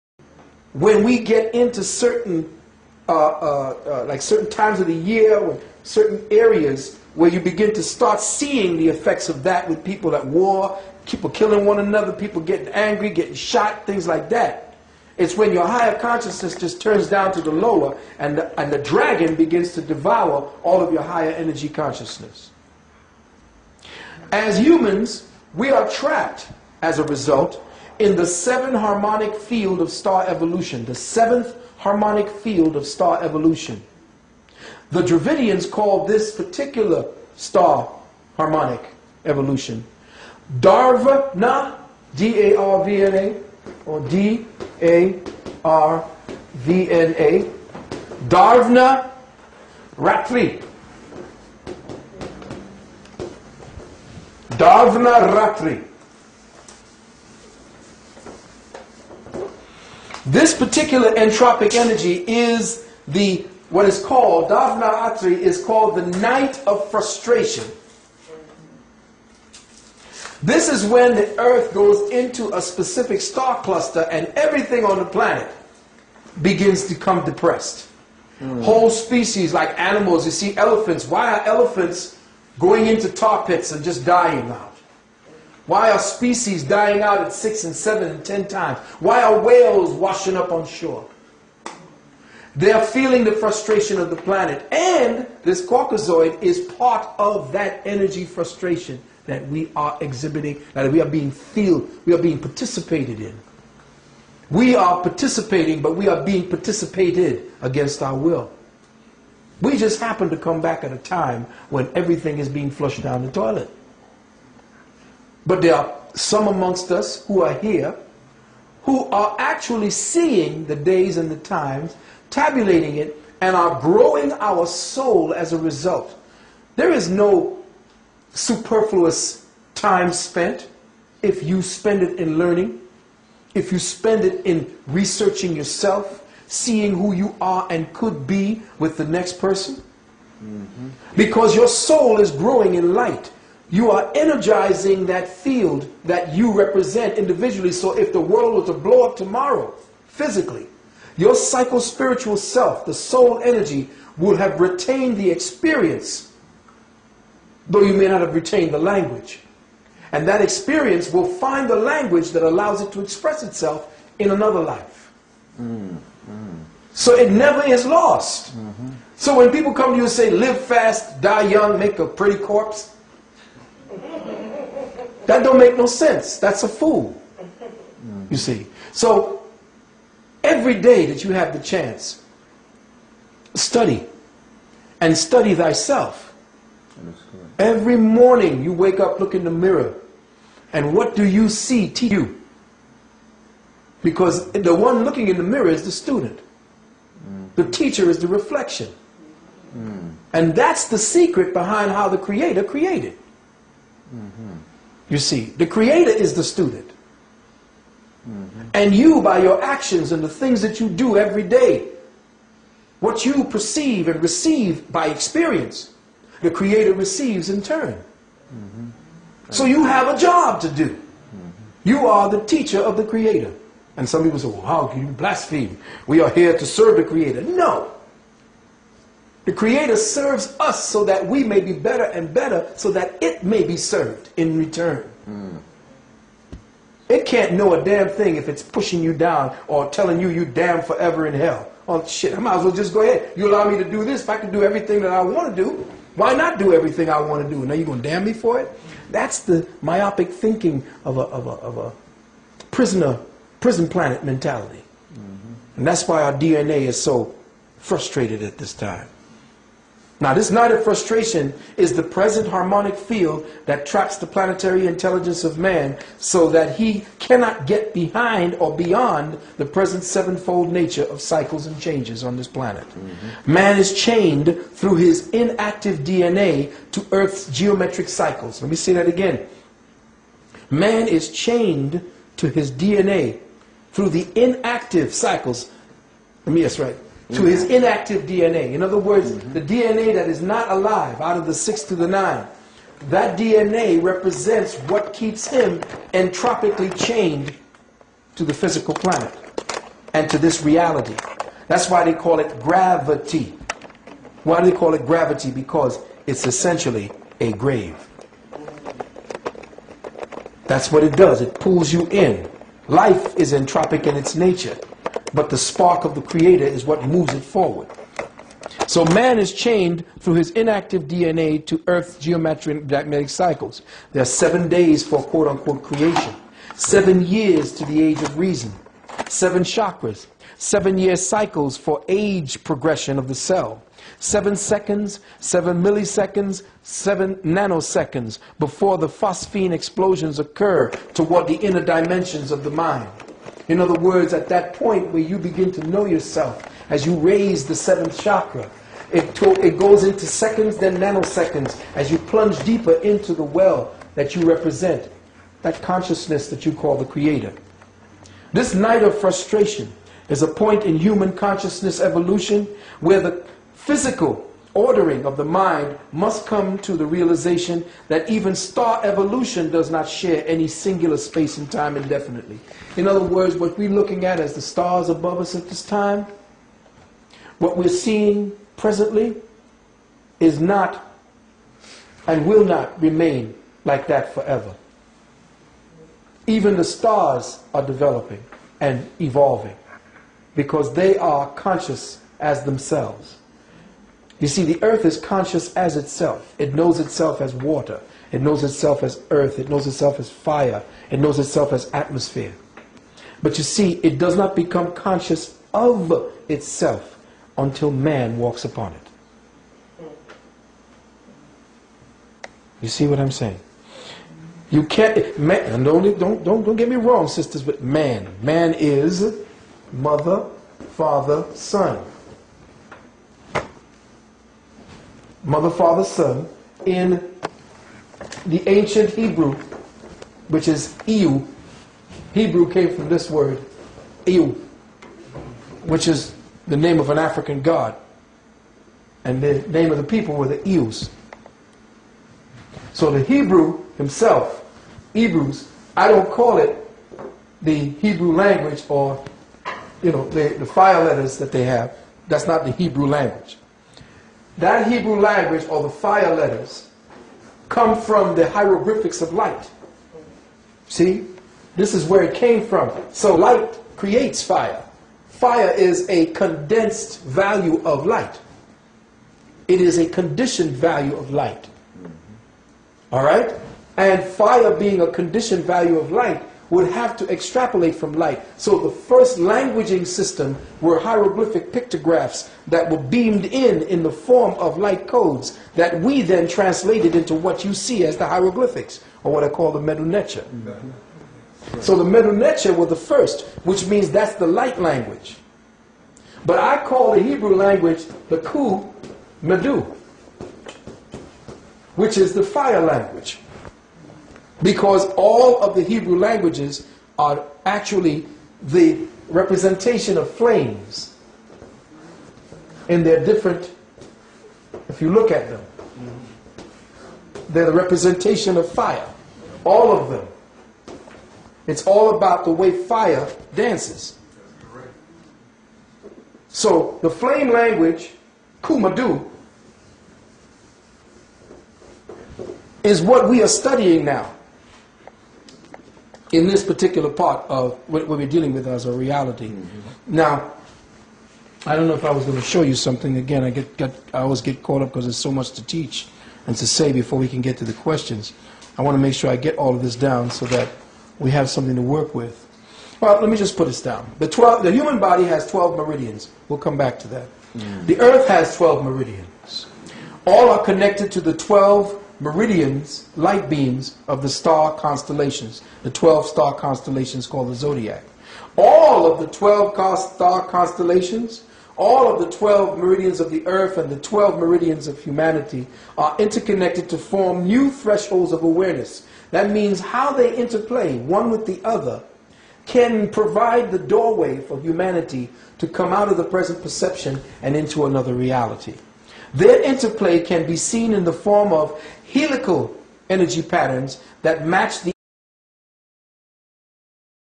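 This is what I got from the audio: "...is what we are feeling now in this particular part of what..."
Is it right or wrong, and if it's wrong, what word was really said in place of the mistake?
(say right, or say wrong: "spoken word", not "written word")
wrong: "studying", not "feeling".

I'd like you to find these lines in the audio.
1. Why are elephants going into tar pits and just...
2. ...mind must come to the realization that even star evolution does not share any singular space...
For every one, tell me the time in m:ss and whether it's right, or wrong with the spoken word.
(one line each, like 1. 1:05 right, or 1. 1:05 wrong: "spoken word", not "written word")
1. 1:21 right
2. 6:05 right.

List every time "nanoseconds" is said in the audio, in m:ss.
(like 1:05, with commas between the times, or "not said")
5:37, 5:50.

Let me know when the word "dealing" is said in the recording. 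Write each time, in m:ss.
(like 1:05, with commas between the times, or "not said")
8:58.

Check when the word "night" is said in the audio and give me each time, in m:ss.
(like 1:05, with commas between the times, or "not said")
1:06, 4:20, 5:58.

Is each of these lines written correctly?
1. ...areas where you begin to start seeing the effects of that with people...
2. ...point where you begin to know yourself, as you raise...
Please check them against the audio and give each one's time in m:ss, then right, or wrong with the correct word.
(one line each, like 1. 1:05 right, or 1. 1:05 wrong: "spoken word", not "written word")
1. 0:06 right
2. 5:44 right.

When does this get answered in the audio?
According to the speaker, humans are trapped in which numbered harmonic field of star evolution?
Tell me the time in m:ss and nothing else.
0:30.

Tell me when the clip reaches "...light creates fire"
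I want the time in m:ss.
7:43.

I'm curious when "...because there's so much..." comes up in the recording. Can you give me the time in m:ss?
9:04.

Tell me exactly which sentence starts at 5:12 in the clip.
Life is entropic in its nature but the spark of the creator is what moves it forward.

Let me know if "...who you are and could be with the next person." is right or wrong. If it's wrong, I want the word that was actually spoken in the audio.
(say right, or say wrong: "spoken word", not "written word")
right.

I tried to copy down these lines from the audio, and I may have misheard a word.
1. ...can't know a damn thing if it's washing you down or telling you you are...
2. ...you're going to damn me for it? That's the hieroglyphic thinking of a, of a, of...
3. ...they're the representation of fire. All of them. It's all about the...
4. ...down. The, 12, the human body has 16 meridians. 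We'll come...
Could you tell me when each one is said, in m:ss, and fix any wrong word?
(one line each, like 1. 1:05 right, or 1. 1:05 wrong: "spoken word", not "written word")
1. 3:57 wrong: "pushing", not "washing"
2. 4:07 wrong: "myopic", not "hieroglyphic"
3. 8:37 right
4. 9:13 wrong: "12", not "16".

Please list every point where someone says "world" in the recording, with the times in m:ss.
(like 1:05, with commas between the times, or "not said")
2:28.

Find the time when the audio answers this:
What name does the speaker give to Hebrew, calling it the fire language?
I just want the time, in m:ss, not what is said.
8:18.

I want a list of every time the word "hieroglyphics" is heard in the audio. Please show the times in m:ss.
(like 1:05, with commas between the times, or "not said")
7:38, 8:00, 8:08.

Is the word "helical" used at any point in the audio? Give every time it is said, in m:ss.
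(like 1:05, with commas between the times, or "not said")
9:52.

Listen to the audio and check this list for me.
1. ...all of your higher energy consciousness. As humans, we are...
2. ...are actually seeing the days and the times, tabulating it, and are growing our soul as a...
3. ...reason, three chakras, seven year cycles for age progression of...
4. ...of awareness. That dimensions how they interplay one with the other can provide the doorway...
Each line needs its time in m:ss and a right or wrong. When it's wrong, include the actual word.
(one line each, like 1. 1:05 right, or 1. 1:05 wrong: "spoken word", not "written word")
1. 0:20 right
2. 1:59 right
3. 5:28 wrong: "seven", not "three"
4. 9:38 wrong: "means", not "dimensions".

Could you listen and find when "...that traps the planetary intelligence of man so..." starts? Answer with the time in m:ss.
4:23.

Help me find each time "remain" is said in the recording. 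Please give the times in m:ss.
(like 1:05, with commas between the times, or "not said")
6:23.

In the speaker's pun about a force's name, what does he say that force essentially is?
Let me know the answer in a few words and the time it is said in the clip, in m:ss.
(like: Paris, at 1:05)
A grave, at 5:06.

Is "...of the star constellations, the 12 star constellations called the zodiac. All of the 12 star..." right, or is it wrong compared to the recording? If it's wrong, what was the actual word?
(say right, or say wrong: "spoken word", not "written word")
right.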